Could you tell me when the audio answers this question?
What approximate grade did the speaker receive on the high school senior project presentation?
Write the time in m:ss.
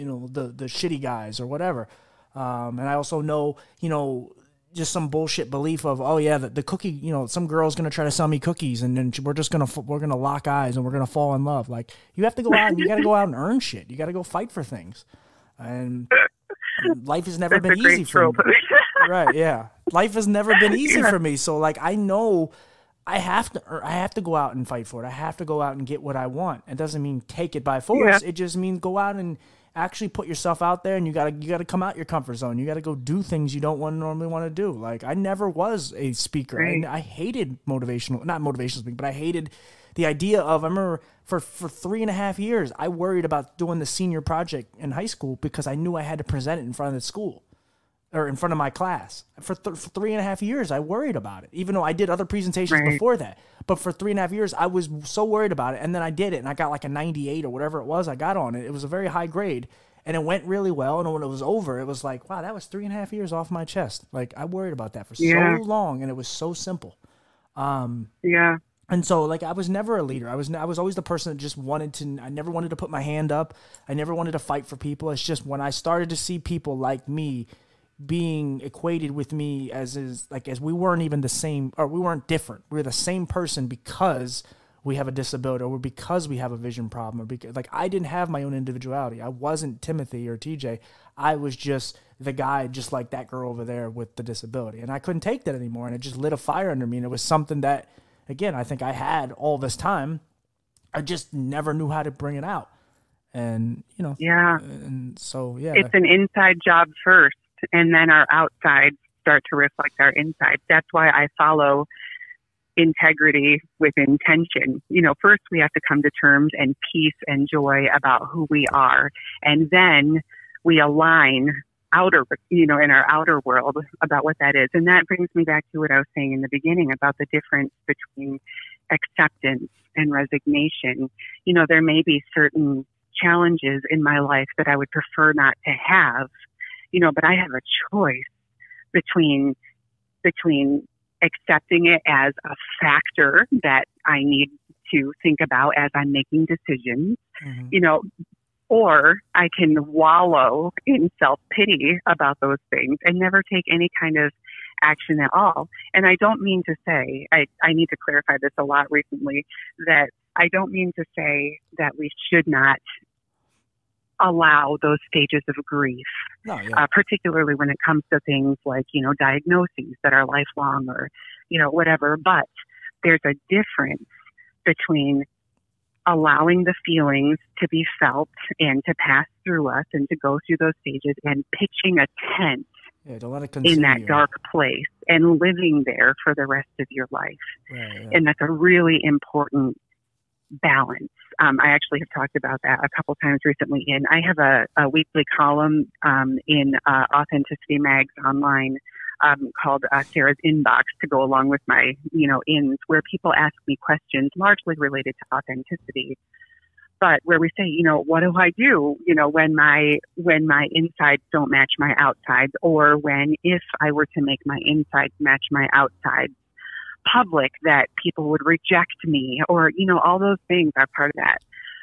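0:56.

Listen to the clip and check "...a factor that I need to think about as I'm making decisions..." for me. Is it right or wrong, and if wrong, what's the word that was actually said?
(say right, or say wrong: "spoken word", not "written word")
right.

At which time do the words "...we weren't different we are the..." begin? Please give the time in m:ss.
1:21.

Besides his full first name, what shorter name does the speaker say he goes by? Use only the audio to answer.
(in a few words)
TJ.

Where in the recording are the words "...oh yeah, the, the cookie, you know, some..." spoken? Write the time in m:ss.
0:06.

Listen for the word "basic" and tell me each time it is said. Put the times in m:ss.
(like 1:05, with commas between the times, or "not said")
not said.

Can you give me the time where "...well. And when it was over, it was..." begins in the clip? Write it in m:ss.
1:00.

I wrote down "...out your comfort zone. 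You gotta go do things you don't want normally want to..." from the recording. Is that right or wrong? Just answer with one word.
right.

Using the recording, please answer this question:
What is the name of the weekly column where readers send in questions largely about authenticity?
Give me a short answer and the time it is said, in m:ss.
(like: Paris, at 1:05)
Sara's Inbox, at 3:20.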